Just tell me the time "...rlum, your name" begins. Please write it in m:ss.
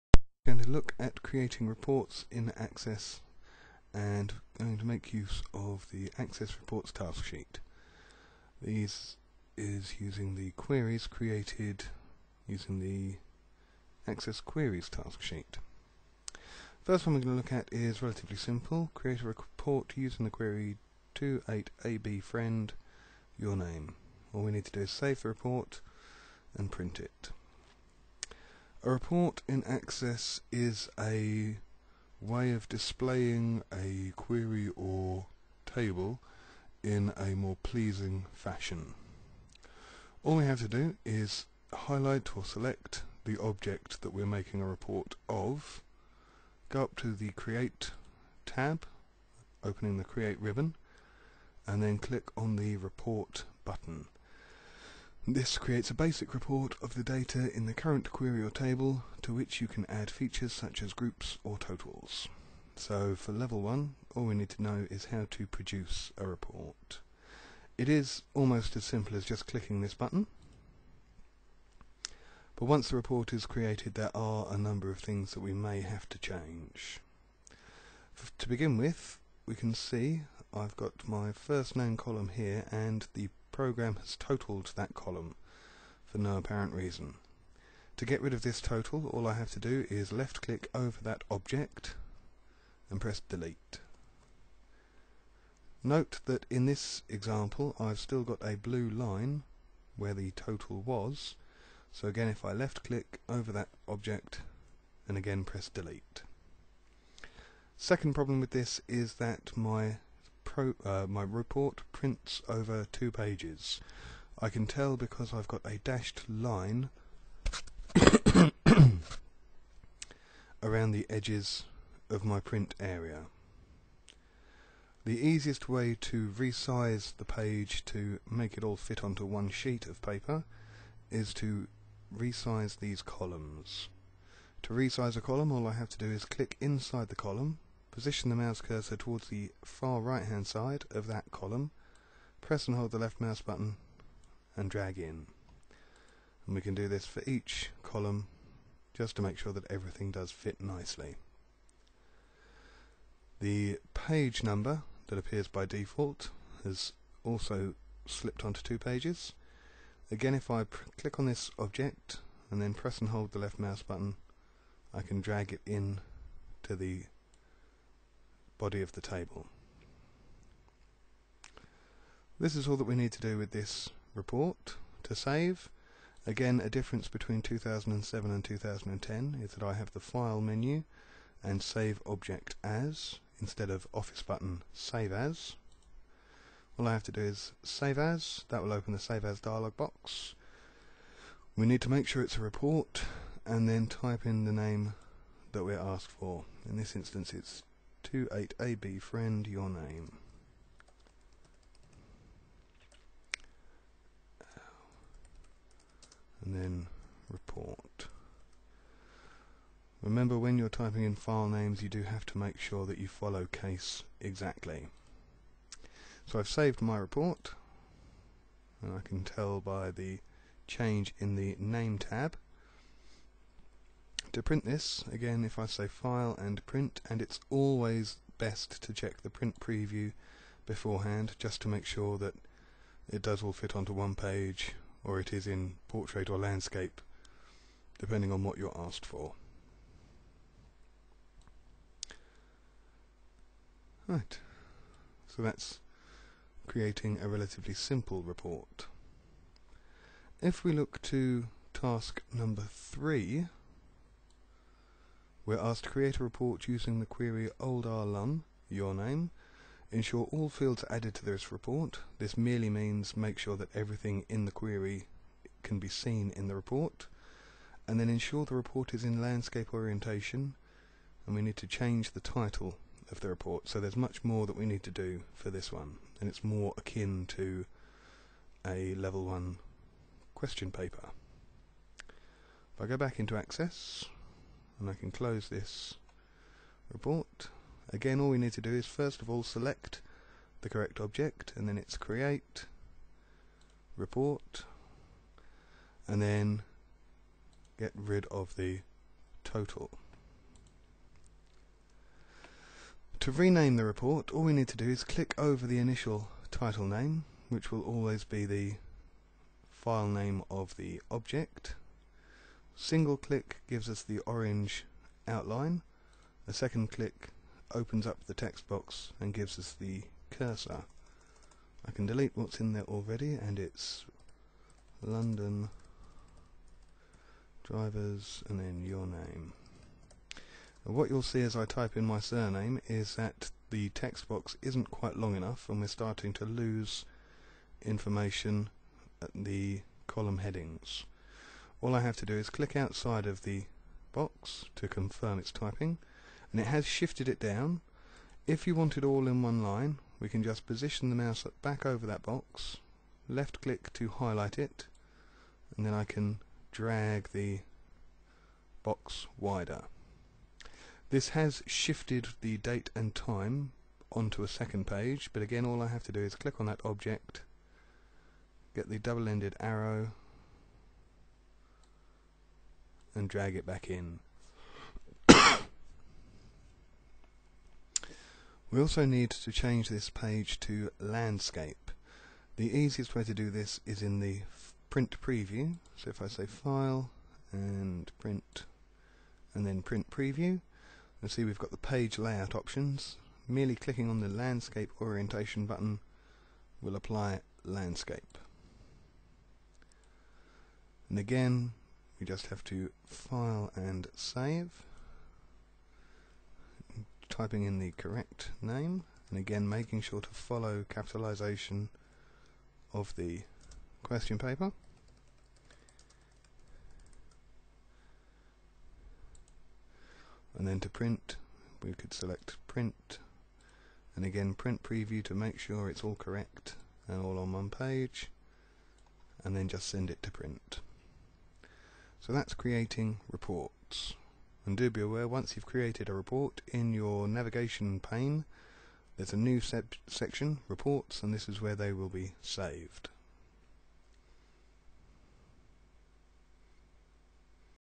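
4:17.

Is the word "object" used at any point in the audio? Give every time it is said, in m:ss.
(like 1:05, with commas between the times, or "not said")
0:43, 1:31, 1:43, 2:41, 3:02, 4:50, 5:11, 6:06.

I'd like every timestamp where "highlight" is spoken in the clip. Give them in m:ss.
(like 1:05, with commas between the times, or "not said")
0:41, 5:54.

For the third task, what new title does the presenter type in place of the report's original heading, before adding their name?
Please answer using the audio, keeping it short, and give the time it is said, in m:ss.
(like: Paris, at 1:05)
London drivers, at 5:25.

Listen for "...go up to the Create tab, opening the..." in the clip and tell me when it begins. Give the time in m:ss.
0:46.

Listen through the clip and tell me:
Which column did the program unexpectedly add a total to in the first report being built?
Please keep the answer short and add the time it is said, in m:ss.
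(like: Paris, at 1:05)
First name, at 1:21.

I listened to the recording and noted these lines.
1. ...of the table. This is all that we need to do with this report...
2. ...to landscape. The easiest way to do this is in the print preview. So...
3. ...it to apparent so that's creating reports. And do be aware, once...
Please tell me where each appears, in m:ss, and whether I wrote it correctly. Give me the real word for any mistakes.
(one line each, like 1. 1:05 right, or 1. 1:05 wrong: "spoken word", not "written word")
1. 2:48 right
2. 6:20 right
3. 7:10 wrong: "print", not "apparent".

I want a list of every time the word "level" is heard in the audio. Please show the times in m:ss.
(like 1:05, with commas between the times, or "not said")
1:03, 4:38.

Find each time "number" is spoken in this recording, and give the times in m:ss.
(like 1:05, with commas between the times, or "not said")
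1:14, 2:34, 4:12.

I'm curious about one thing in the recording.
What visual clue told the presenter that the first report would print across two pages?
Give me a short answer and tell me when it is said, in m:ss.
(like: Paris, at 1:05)
A dashed line, at 1:55.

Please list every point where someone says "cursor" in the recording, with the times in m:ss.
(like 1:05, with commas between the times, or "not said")
2:18, 5:20.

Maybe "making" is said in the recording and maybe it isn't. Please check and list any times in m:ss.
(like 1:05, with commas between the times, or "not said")
0:44, 6:49.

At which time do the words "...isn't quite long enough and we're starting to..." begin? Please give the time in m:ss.
5:34.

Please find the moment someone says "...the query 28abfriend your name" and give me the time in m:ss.
0:20.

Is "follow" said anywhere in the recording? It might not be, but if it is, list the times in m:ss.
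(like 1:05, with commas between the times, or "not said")
3:33, 6:50.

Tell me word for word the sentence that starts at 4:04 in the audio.
Right, so that's creating a relatively simple report.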